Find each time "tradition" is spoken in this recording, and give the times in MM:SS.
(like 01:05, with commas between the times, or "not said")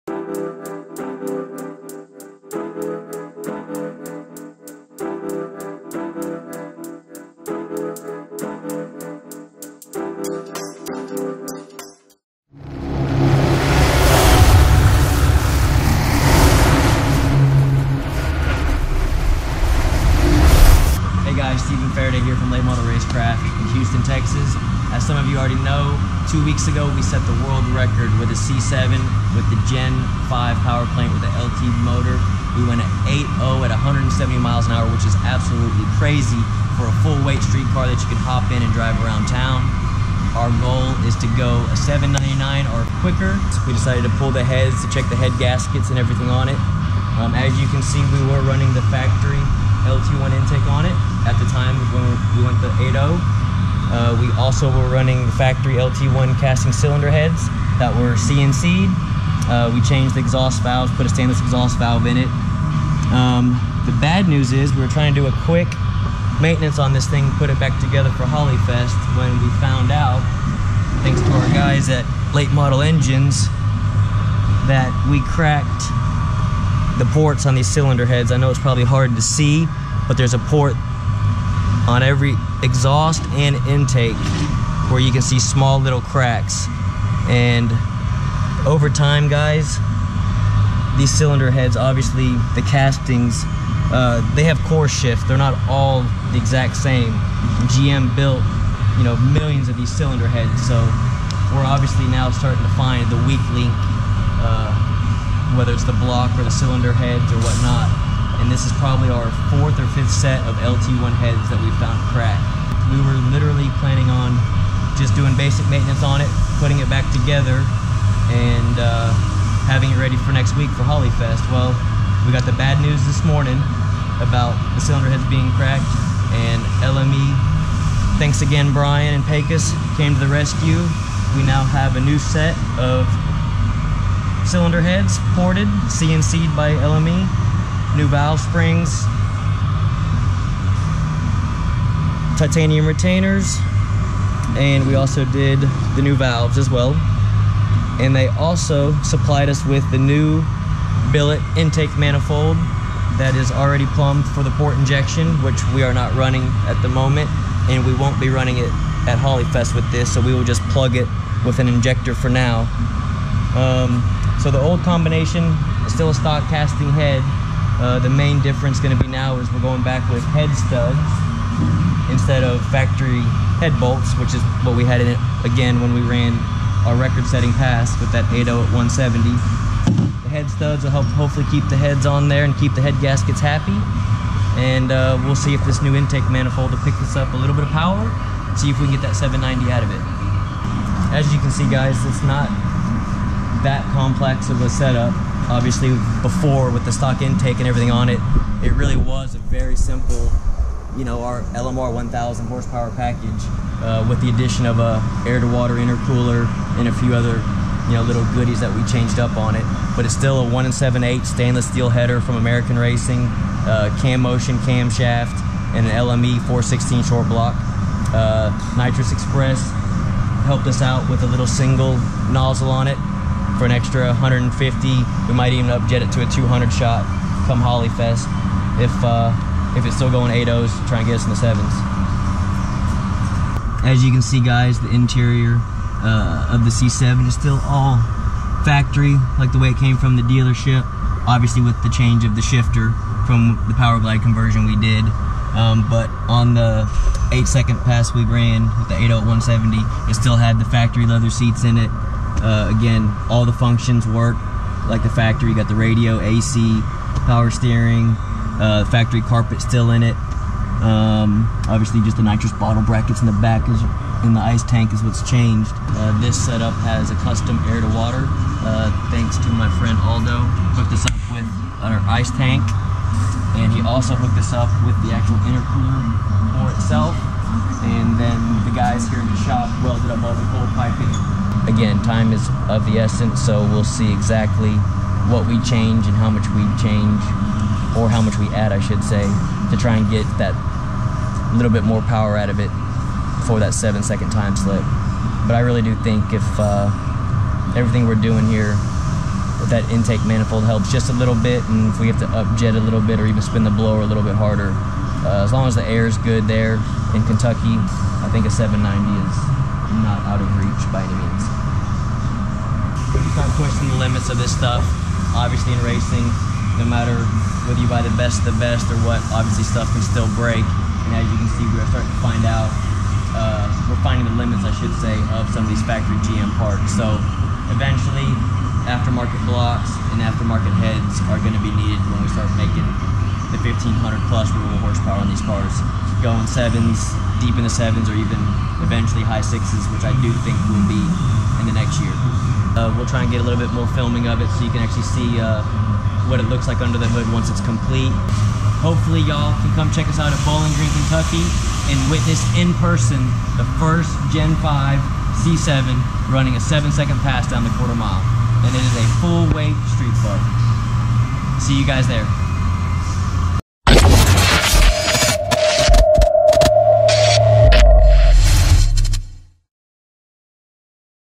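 not said.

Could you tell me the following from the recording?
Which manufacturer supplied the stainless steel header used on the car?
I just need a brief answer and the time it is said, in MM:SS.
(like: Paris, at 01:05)
American Racing, at 03:32.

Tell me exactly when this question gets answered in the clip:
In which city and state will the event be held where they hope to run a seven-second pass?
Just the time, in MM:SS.
05:50.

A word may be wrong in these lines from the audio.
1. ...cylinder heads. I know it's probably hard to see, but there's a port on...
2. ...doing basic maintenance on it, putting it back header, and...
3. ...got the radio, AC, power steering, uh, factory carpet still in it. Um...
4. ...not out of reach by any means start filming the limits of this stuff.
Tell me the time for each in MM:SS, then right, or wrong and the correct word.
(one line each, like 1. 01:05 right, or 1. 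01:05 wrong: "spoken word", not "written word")
1. 01:17 right
2. 01:55 wrong: "together", not "header"
3. 04:15 right
4. 05:10 wrong: "pushing", not "filming".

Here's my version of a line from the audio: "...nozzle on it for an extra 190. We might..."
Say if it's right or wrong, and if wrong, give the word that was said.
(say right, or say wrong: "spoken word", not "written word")
wrong: "150", not "190".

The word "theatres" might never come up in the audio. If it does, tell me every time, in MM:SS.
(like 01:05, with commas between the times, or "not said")
not said.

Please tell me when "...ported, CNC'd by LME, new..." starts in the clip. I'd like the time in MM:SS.
02:15.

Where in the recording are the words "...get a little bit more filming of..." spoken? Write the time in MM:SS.
05:43.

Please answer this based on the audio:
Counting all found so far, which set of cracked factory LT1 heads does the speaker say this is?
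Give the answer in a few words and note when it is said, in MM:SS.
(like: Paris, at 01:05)
fourth or fifth, at 01:49.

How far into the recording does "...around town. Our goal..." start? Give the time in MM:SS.
00:39.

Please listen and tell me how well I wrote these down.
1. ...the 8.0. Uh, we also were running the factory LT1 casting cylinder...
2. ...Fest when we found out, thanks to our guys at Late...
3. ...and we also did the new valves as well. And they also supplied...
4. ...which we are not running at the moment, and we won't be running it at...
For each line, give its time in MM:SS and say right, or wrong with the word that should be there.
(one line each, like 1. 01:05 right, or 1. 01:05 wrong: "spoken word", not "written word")
1. 00:52 right
2. 01:08 right
3. 02:24 right
4. 02:35 right.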